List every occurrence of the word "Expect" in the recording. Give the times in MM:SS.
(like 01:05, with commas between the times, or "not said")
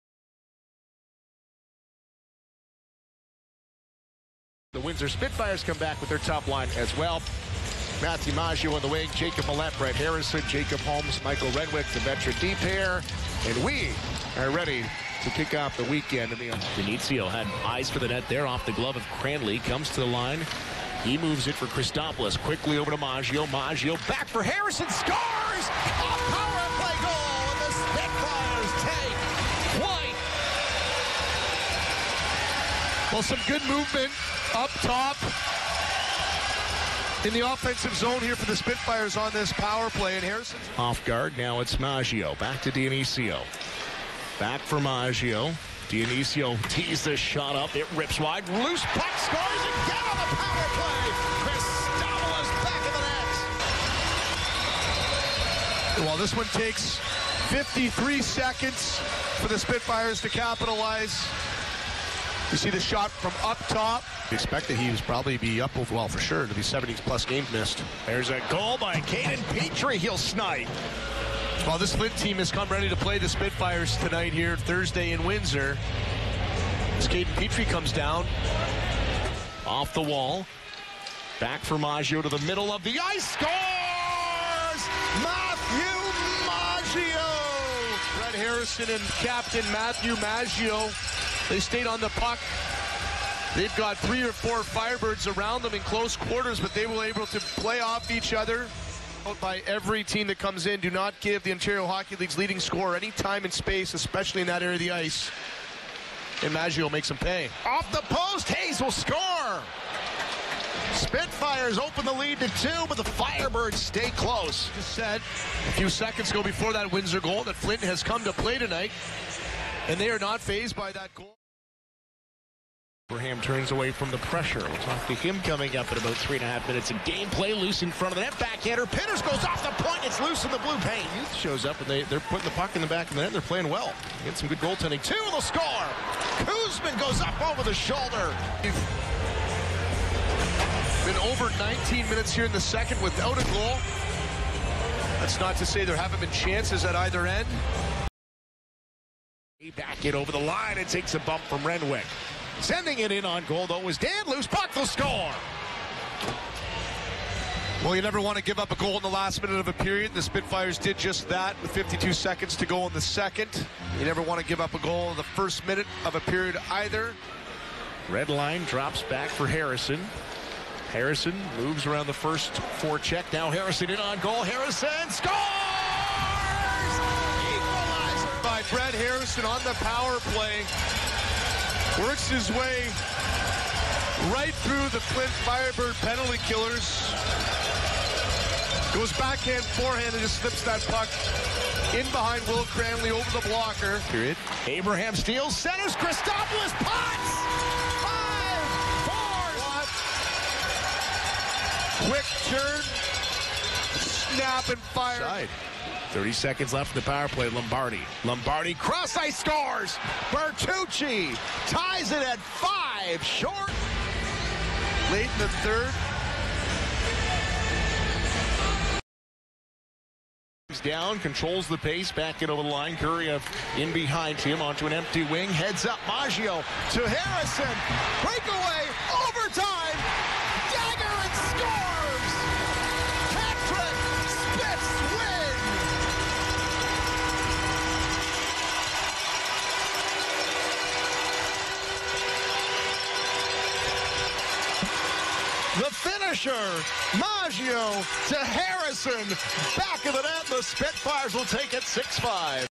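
01:04.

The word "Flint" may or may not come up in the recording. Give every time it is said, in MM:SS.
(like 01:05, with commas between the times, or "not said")
01:11, 01:57, 03:05.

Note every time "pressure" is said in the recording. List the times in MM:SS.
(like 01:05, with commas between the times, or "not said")
02:04.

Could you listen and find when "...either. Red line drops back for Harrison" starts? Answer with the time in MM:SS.
02:46.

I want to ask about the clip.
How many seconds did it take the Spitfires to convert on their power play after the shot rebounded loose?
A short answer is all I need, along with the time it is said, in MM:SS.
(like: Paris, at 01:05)
53, at 00:57.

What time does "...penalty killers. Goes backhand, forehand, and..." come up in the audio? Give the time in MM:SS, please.
03:06.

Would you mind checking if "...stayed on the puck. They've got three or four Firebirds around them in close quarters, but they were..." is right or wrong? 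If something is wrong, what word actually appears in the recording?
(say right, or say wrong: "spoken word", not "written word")
right.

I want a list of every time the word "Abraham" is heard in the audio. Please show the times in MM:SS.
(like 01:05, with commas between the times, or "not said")
02:03, 03:14.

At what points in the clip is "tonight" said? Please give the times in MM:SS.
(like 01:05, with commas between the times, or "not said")
01:13, 01:58.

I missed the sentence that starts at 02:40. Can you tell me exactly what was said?
The Spitfires did just that with 52 seconds to go in the second.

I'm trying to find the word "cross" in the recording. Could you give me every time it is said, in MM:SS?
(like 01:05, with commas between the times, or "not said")
03:28.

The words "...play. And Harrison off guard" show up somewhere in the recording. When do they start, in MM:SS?
00:39.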